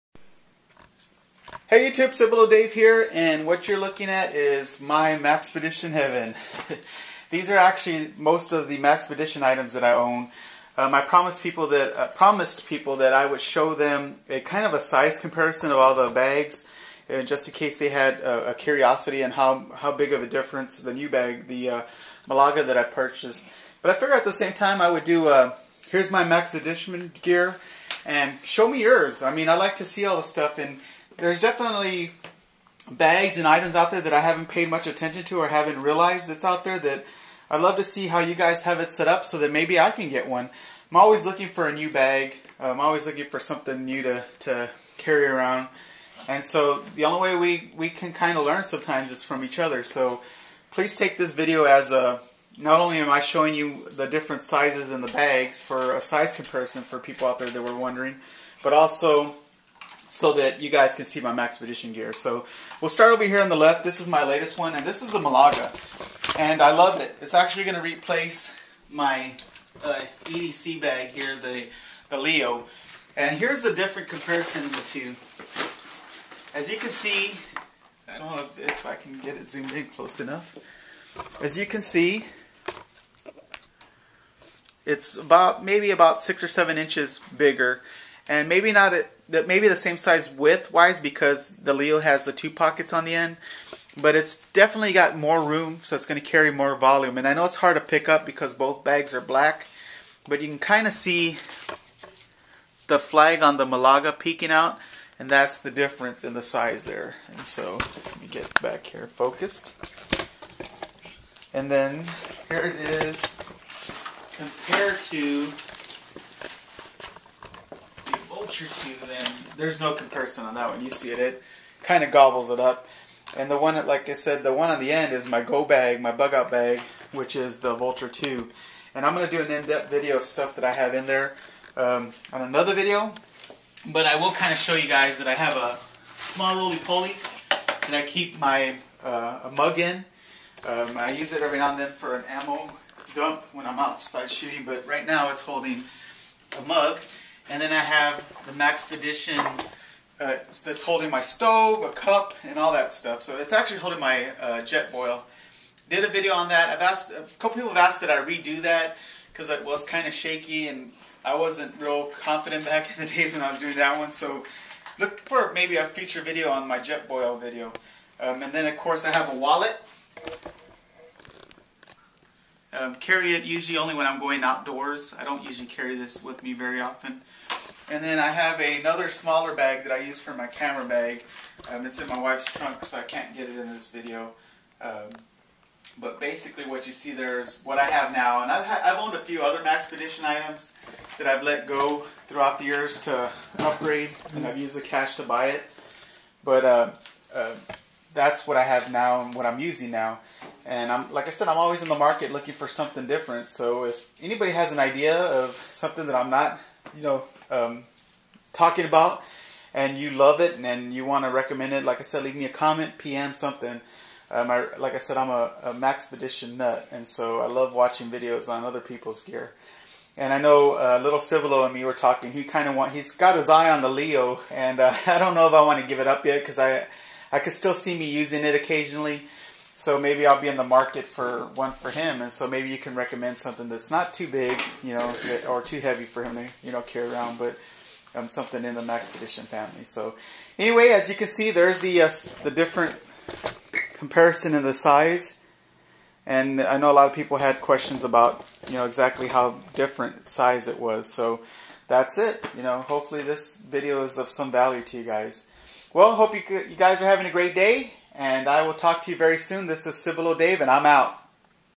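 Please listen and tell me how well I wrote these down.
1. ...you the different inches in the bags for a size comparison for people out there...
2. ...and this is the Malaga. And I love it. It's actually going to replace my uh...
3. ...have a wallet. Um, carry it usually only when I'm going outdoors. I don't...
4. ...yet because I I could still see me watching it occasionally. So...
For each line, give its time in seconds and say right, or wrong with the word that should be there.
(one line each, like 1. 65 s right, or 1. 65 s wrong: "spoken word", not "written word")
1. 53 s wrong: "sizes", not "inches"
2. 64 s right
3. 169 s right
4. 226 s wrong: "using", not "watching".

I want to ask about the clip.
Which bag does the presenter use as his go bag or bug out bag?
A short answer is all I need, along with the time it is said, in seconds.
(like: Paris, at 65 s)
Vulture 2, at 127 s.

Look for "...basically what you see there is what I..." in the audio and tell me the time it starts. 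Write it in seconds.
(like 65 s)
186 s.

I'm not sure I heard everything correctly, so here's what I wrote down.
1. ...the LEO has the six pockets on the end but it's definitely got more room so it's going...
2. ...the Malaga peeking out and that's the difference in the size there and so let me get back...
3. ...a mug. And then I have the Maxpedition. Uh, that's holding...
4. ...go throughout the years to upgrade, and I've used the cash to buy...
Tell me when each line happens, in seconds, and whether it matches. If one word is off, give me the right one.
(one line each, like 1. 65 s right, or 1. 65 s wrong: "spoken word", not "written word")
1. 91 s wrong: "two", not "six"
2. 103 s right
3. 146 s right
4. 191 s right.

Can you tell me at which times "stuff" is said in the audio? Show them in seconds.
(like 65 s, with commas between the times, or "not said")
30 s, 130 s, 152 s.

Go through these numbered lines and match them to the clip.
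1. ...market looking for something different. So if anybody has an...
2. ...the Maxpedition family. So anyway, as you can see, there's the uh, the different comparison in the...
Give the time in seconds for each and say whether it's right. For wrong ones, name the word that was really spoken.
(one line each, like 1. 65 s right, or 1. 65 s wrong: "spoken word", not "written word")
1. 201 s right
2. 238 s right.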